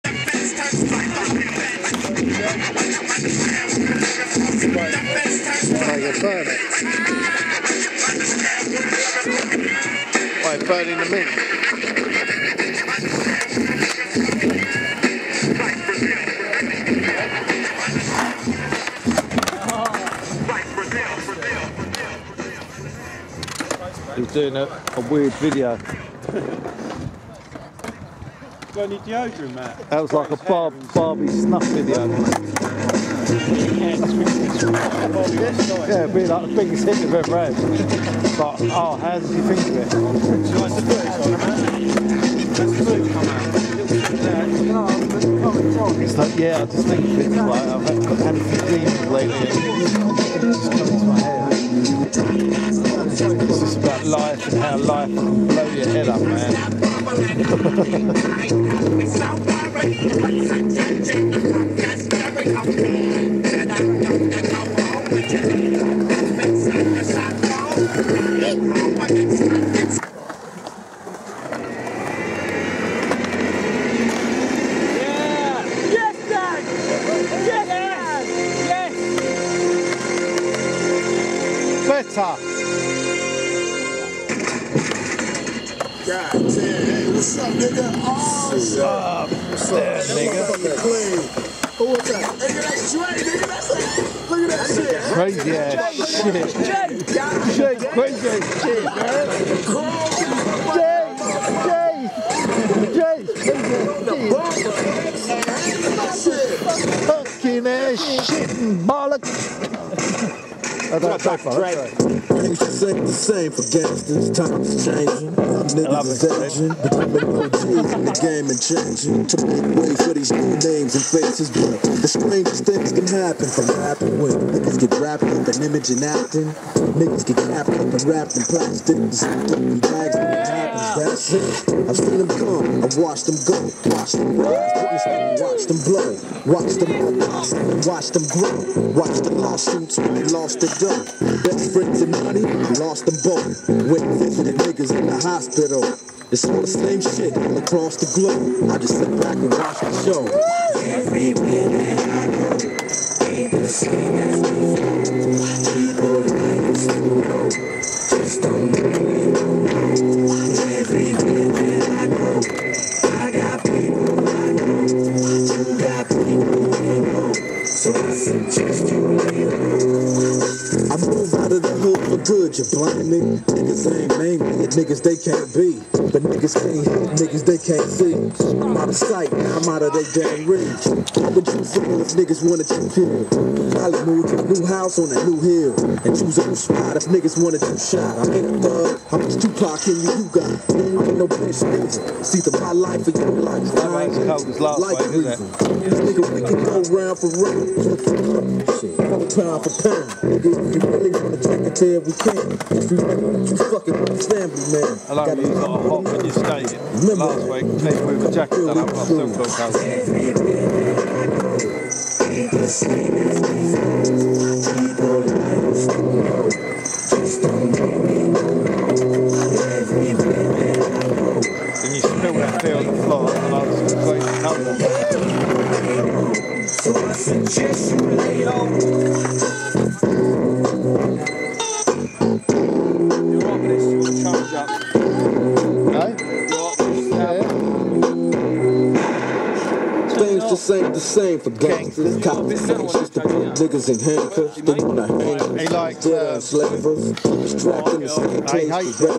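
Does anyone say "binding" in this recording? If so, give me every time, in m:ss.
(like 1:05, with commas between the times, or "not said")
not said.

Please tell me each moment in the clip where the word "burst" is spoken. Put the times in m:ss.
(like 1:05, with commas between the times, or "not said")
not said.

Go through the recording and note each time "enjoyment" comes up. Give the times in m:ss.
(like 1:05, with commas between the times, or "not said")
not said.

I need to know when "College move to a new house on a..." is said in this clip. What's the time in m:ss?
3:03.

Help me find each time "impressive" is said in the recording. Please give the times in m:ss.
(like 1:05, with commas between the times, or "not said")
not said.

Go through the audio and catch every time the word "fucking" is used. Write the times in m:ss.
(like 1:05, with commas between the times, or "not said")
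3:23.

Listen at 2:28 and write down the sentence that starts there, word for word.
I just sit back and watch the show.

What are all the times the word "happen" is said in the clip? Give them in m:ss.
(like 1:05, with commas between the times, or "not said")
2:03, 2:10.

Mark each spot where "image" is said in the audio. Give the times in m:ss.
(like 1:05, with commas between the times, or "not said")
2:05.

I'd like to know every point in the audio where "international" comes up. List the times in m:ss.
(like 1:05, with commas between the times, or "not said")
not said.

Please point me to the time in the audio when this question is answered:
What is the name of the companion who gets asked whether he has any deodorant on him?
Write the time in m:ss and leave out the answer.
0:29.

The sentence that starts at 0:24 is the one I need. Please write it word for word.
He's doing a, a weird video.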